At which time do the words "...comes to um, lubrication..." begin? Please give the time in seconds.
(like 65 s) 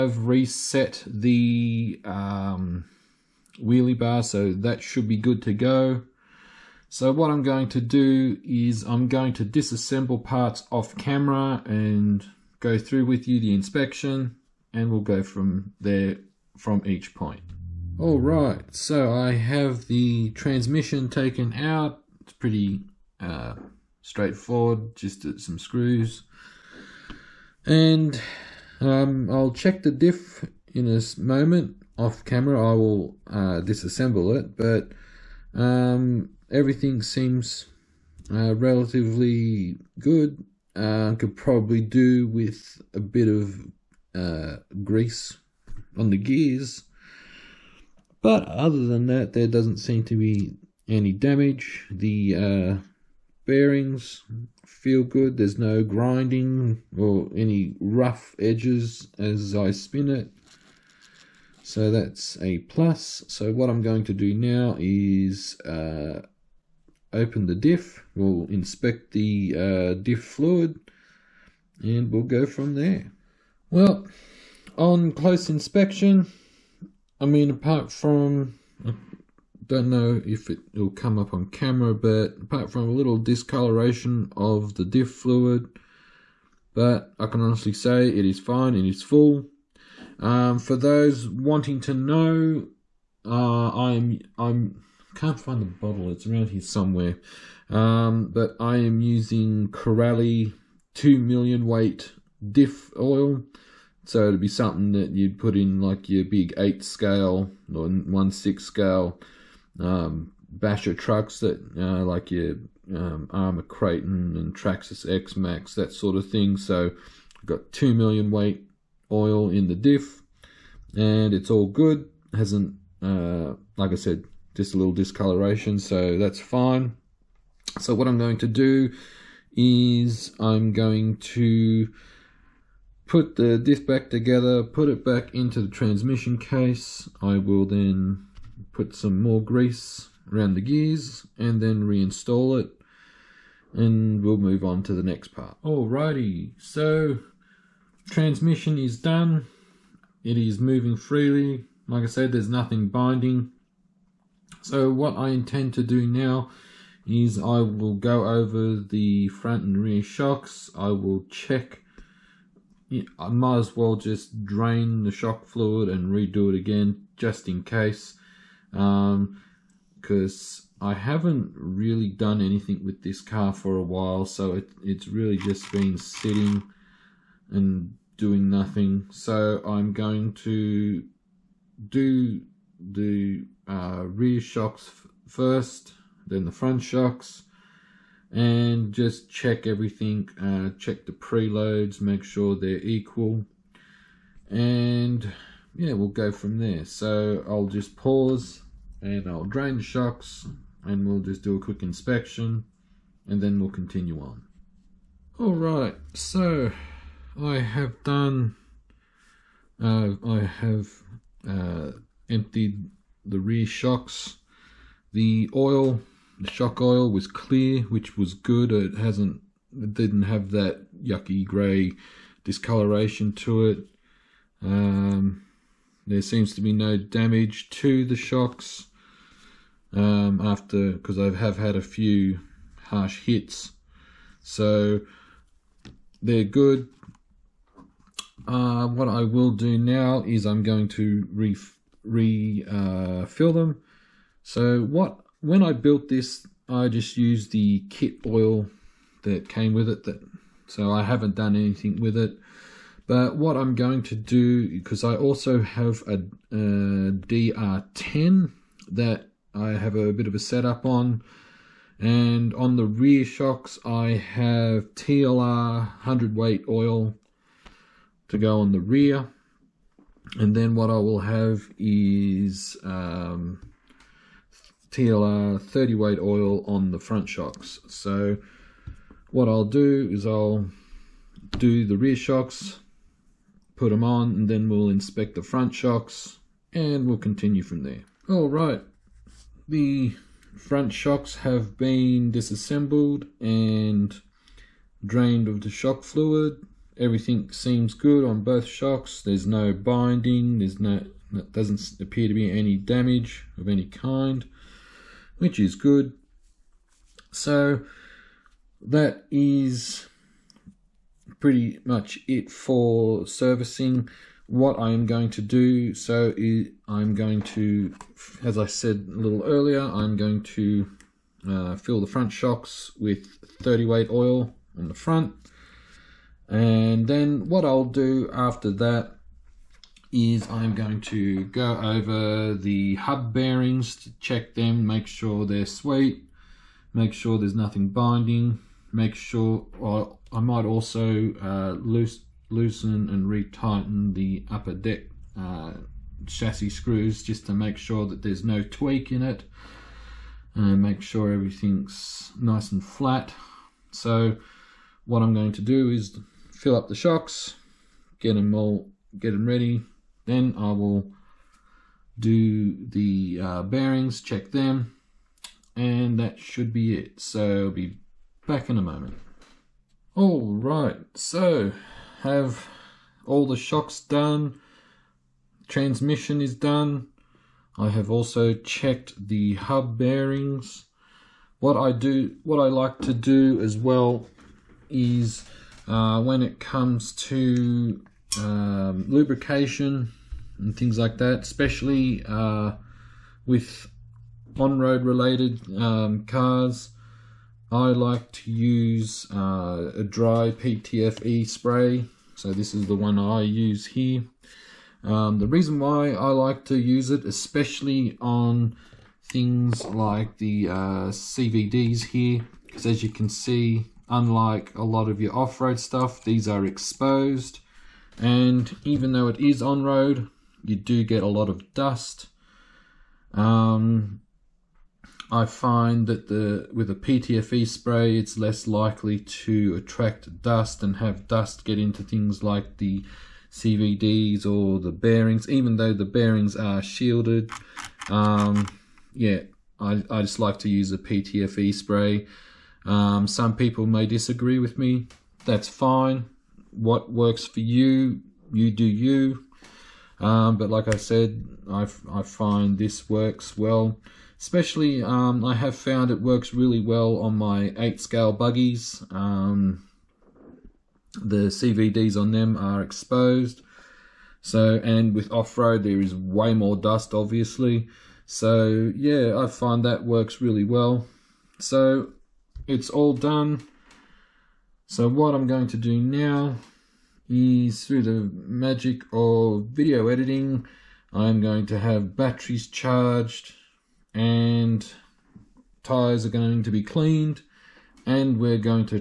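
386 s.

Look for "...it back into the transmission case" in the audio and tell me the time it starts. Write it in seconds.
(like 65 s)
134 s.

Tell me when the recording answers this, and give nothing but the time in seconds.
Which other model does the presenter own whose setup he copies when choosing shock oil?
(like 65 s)
256 s.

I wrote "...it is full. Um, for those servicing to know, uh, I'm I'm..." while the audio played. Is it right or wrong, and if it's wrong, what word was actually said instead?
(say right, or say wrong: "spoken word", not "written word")
wrong: "wanting", not "servicing".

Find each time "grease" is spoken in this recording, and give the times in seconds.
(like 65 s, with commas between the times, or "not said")
44 s, 139 s.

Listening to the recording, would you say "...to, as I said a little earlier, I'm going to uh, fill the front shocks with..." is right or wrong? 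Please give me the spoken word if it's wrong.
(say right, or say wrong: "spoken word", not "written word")
right.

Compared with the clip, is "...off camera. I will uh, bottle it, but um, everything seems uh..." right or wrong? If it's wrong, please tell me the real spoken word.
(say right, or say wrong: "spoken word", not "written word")
wrong: "disassemble", not "bottle".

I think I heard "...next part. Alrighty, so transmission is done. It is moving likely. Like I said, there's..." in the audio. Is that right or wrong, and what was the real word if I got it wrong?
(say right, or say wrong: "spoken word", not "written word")
wrong: "freely", not "likely".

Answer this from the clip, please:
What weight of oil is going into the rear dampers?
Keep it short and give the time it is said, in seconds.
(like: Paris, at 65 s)
100 weight, at 265 s.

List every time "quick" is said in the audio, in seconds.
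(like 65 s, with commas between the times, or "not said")
201 s.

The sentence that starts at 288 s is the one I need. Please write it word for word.
All right, the front shocks have been disassembled and drained of the shock fluid.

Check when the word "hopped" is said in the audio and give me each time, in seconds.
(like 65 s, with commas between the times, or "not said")
not said.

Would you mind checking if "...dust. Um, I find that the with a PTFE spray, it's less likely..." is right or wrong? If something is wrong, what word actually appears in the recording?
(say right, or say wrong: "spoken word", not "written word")
right.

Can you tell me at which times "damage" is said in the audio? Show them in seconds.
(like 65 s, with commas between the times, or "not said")
51 s, 226 s, 302 s.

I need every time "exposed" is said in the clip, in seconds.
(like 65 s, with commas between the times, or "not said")
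416 s, 462 s.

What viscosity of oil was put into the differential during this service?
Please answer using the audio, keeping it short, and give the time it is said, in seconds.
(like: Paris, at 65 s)
2 million weight, at 117 s.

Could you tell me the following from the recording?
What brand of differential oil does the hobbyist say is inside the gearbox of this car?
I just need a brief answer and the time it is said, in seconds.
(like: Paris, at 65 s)
Corally, at 99 s.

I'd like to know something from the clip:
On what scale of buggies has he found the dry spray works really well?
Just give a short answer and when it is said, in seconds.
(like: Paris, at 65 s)
8 scale, at 457 s.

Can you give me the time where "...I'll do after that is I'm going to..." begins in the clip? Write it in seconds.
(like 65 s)
327 s.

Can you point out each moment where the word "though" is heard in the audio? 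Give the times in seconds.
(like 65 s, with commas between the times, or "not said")
419 s, 435 s.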